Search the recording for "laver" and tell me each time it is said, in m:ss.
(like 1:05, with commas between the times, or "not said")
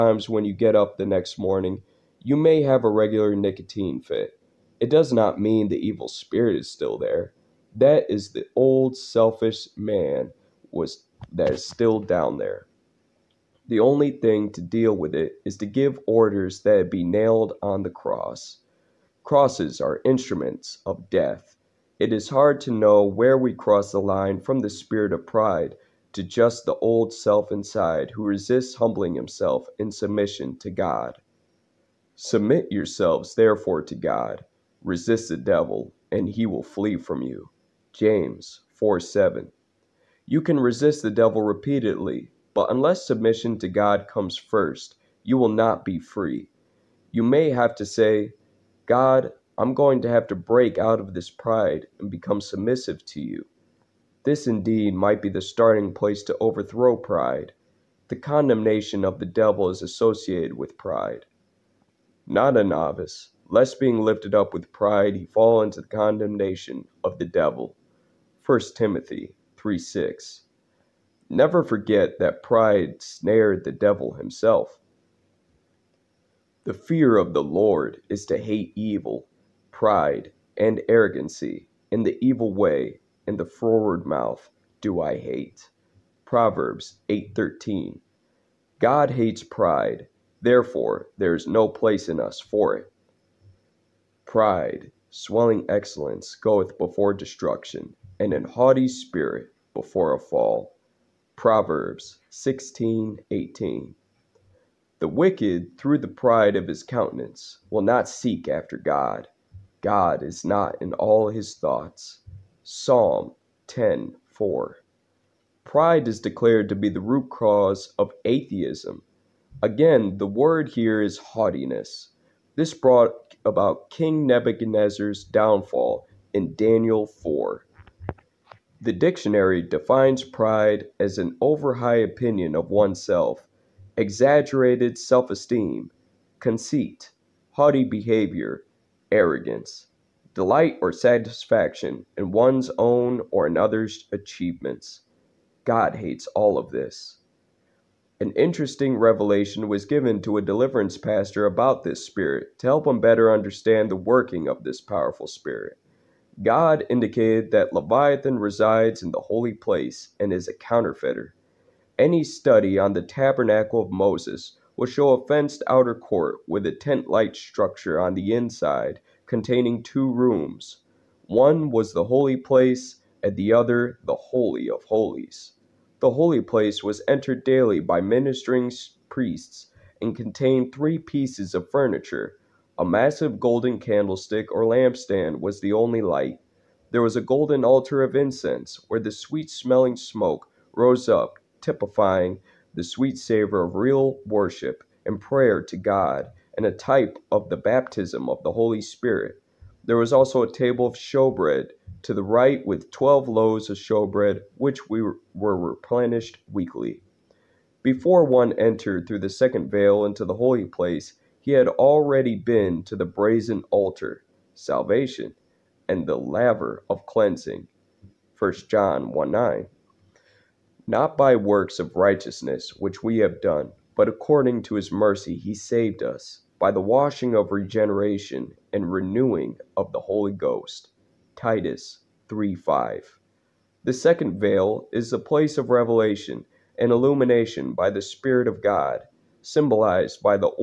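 3:36.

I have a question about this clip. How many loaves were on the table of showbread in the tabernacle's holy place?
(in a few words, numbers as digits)
12.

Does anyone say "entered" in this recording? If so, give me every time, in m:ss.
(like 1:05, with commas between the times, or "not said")
2:57, 3:28.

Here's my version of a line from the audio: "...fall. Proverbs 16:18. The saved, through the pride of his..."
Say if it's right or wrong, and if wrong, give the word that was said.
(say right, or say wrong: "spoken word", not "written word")
wrong: "wicked", not "saved".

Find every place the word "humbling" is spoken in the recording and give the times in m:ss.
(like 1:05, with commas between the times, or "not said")
0:28.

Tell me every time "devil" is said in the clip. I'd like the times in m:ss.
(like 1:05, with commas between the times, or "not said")
0:35, 0:41, 0:59, 1:07, 1:13.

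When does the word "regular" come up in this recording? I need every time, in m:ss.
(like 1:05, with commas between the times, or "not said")
0:02.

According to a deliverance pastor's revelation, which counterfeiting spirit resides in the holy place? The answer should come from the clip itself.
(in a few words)
Leviathan.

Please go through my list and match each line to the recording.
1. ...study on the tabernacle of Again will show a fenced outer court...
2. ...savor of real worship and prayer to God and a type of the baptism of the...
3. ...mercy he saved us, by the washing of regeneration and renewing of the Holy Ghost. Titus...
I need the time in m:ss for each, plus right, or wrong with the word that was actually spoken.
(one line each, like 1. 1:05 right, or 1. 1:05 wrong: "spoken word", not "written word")
1. 2:42 wrong: "Moses", not "Again"
2. 3:13 right
3. 3:44 right.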